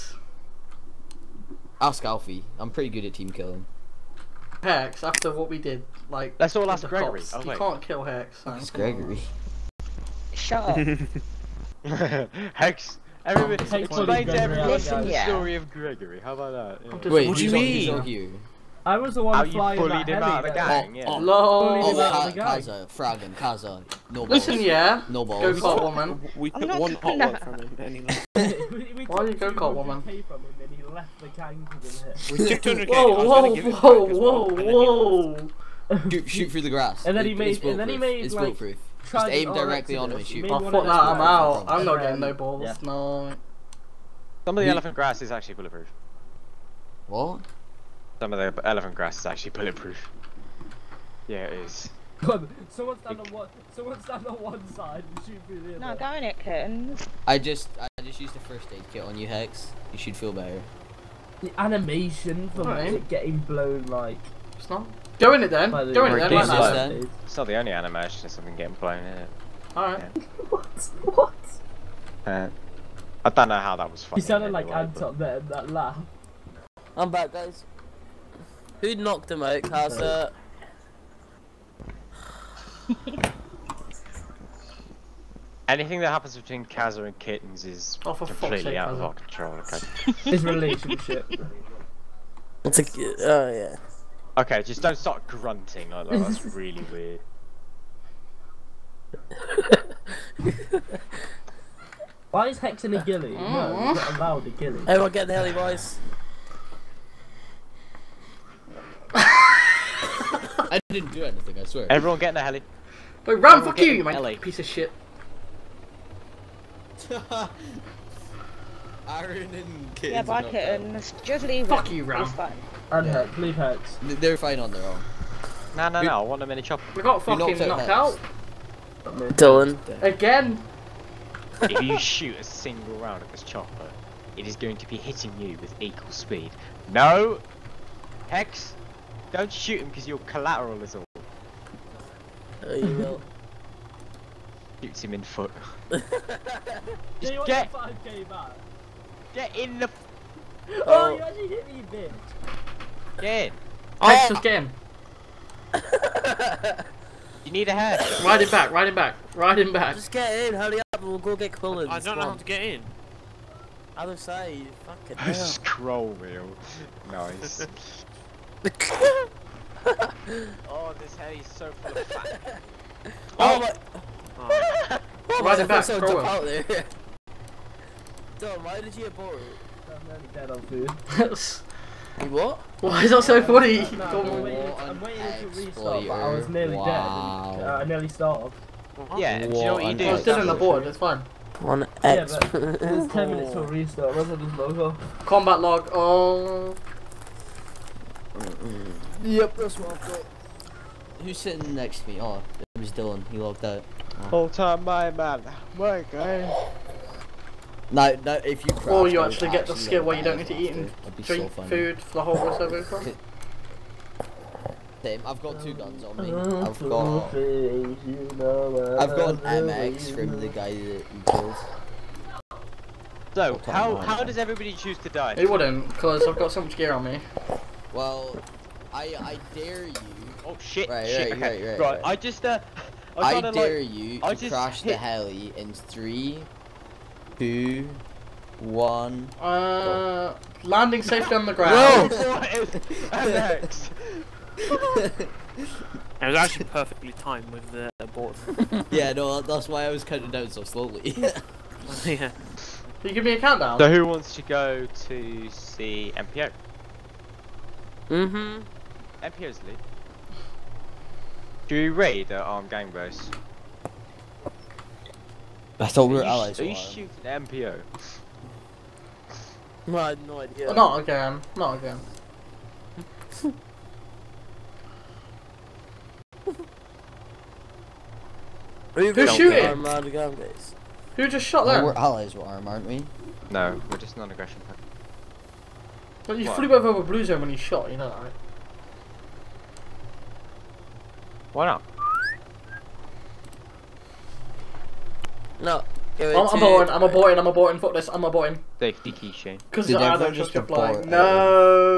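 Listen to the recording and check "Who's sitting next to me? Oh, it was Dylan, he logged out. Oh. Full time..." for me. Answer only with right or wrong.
right.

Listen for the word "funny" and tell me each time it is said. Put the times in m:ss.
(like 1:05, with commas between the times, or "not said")
1:14, 3:03.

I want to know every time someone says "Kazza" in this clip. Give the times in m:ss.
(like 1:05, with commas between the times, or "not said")
1:19, 1:26.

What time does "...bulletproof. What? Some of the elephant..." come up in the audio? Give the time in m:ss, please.
0:45.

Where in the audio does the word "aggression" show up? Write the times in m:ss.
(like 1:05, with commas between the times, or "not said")
4:44.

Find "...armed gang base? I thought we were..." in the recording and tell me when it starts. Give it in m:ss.
4:22.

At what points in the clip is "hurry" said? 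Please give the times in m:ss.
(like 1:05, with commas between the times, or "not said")
2:40.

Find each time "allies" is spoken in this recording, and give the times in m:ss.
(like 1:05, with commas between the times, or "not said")
4:26, 4:41.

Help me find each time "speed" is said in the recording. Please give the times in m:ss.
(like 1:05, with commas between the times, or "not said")
2:16.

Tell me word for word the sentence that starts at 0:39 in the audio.
Just aim directly on him and shoot.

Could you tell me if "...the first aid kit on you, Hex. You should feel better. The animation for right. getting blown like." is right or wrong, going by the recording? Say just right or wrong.
right.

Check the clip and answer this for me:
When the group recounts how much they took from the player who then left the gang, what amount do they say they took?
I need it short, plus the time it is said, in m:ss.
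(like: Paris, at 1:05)
200k, at 0:32.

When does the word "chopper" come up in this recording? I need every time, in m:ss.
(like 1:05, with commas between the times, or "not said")
2:06, 2:13.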